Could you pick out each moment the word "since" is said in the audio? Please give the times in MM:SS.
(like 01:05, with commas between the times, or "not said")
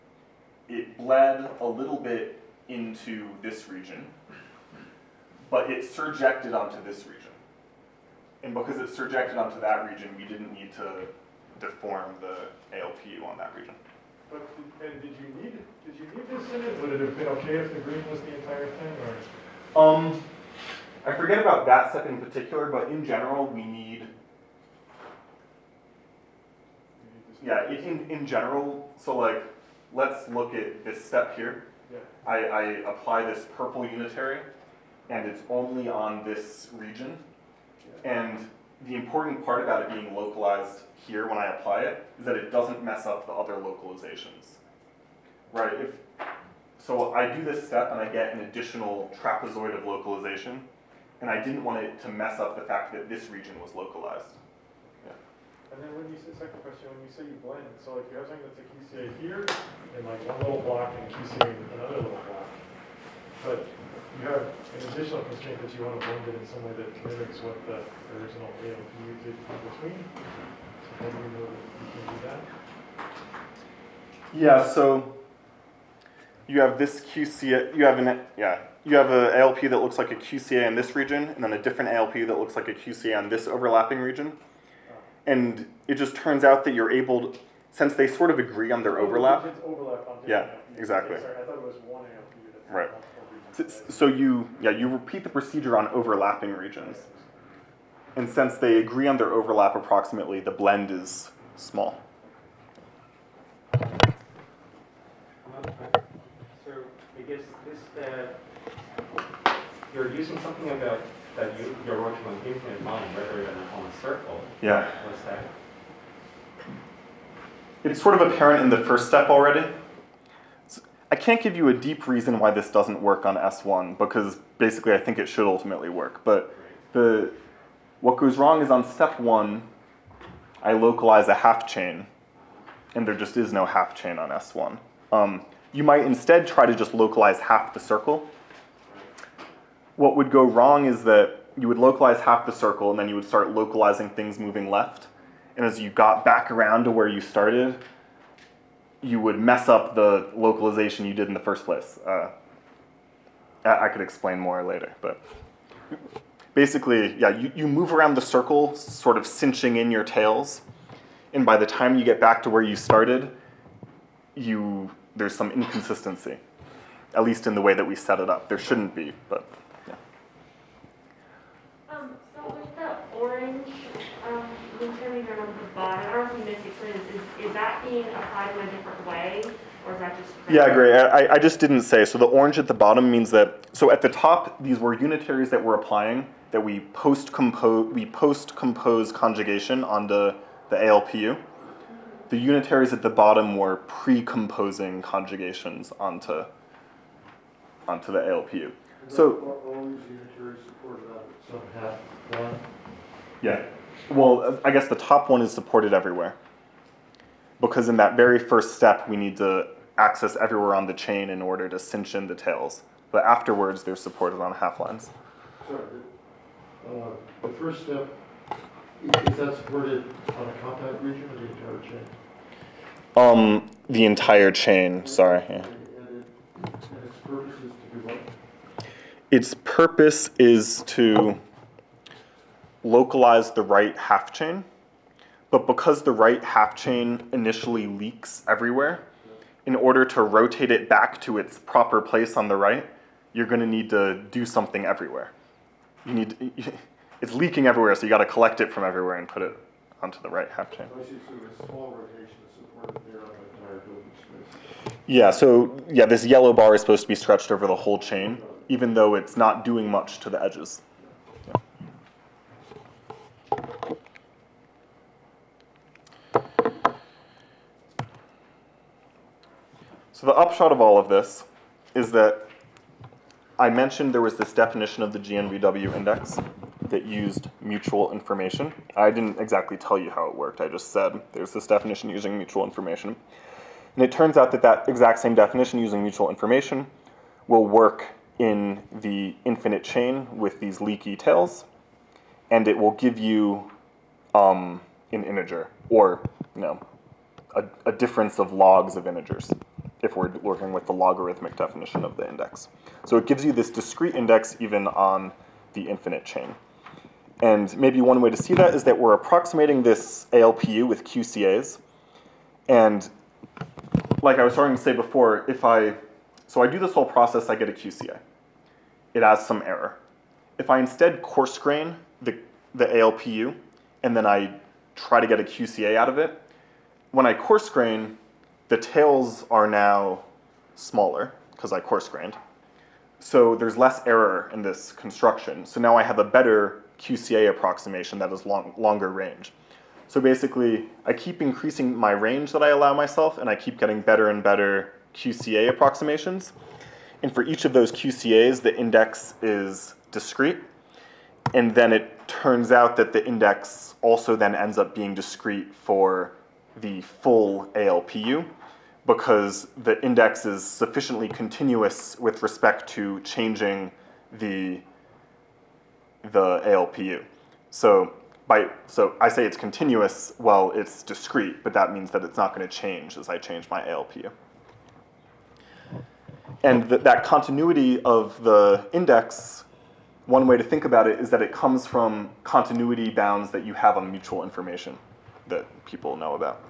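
01:27, 01:38.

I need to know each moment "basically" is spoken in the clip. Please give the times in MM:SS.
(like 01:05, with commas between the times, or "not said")
02:04, 02:36, 05:40.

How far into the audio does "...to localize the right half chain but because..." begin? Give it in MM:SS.
03:50.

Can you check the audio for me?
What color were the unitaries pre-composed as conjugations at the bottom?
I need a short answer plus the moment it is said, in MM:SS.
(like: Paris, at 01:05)
orange, at 03:02.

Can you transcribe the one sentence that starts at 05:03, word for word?
So it gives you this discrete index even on the infinite chain.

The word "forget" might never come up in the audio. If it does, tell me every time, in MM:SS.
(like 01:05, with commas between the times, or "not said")
00:21.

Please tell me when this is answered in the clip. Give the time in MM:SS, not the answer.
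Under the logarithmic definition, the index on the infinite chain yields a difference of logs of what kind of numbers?
04:59.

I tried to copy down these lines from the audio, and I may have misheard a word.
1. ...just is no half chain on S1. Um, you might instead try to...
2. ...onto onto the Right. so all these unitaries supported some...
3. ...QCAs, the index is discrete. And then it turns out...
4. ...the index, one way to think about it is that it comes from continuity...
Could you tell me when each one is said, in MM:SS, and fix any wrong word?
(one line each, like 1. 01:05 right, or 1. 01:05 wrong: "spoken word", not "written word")
1. 02:13 right
2. 03:16 wrong: "ALPU", not "Right"
3. 05:47 right
4. 06:18 right.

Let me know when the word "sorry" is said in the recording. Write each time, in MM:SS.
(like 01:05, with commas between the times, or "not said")
01:31, 03:35, 03:45.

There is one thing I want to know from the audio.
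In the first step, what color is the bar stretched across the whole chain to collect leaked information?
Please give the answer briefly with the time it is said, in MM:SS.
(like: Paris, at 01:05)
yellow, at 04:16.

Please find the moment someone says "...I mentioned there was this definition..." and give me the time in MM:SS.
04:33.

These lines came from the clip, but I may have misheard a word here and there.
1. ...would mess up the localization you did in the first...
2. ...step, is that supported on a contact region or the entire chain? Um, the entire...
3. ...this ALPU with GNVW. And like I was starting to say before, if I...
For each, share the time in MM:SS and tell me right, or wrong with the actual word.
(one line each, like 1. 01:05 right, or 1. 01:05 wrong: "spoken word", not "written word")
1. 02:29 right
2. 03:37 right
3. 05:09 wrong: "QCAs", not "GNVW".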